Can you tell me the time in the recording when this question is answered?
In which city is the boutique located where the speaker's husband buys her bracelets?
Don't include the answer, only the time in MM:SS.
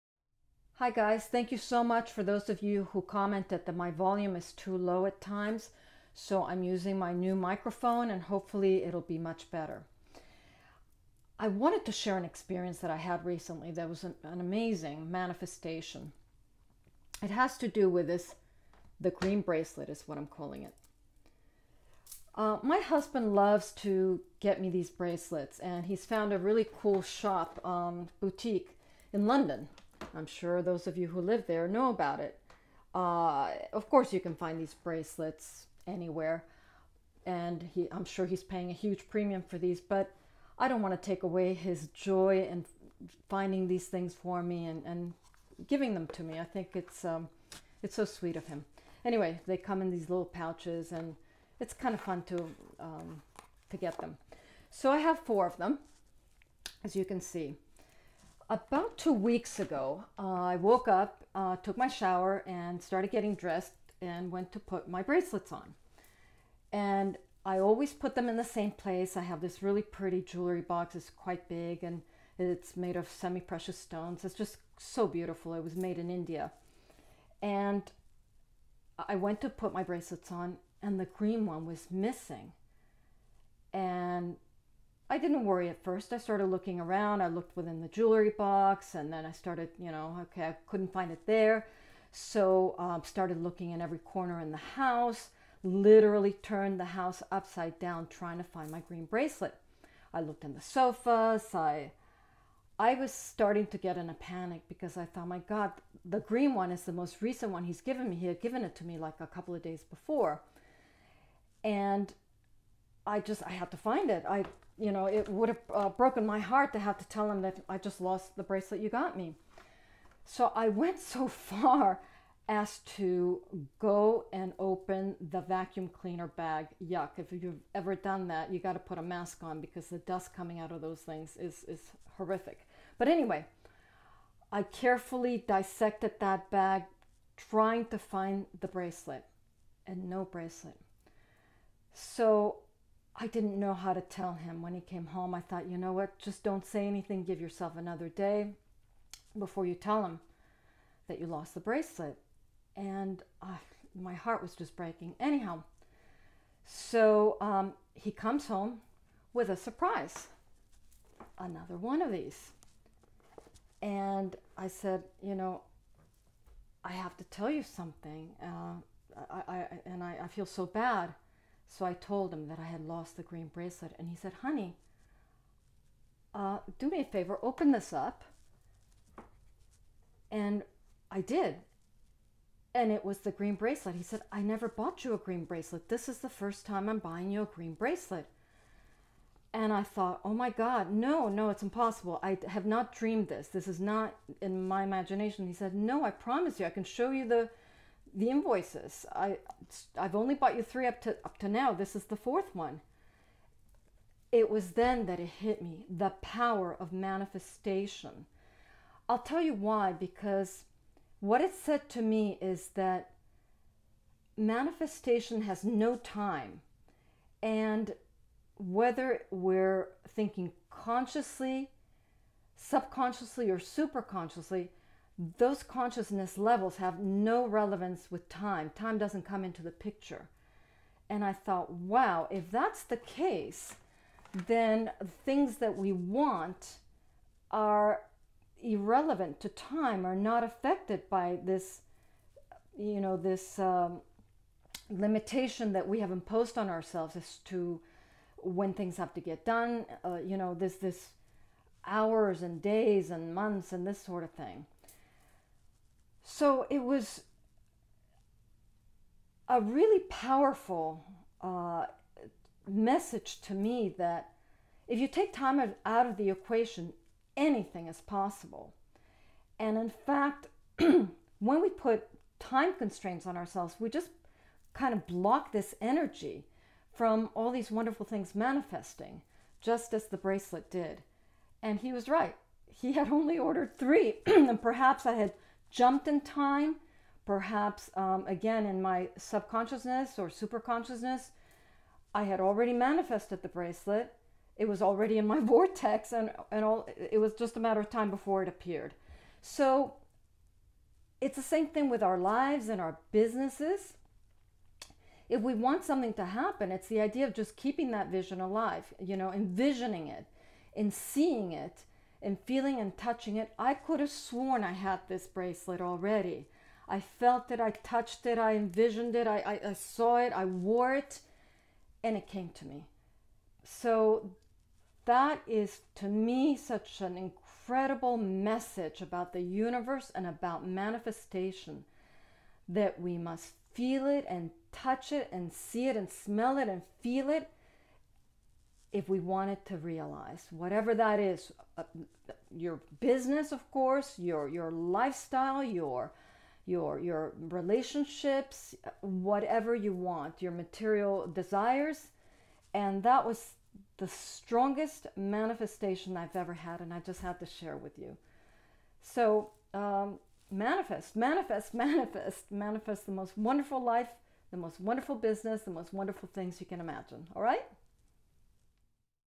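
00:29.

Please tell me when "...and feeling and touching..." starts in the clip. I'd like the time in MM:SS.
05:12.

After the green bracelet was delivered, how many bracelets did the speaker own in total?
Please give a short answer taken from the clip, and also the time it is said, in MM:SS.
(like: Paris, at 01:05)
4, at 00:55.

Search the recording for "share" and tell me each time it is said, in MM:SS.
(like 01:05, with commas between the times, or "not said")
00:11, 05:57.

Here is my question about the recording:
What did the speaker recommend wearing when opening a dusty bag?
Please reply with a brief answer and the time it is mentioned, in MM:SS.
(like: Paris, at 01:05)
A mask, at 02:09.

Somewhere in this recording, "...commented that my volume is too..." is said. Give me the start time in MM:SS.
00:03.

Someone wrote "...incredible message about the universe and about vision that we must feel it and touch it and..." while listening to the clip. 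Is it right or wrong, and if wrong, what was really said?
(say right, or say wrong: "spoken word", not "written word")
wrong: "manifestation", not "vision".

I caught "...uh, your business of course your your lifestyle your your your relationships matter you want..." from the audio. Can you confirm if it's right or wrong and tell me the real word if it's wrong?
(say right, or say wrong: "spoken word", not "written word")
wrong: "whatever", not "matter".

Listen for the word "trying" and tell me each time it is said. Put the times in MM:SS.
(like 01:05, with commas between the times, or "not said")
01:38, 02:17.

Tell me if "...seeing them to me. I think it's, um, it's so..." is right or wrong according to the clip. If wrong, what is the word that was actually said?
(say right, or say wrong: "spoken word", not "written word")
wrong: "giving", not "seeing".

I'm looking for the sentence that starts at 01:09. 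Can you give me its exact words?
I have this really pretty jewelry box.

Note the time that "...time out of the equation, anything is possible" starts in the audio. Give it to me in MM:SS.
04:25.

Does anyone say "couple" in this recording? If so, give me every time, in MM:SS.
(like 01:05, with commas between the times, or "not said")
01:49.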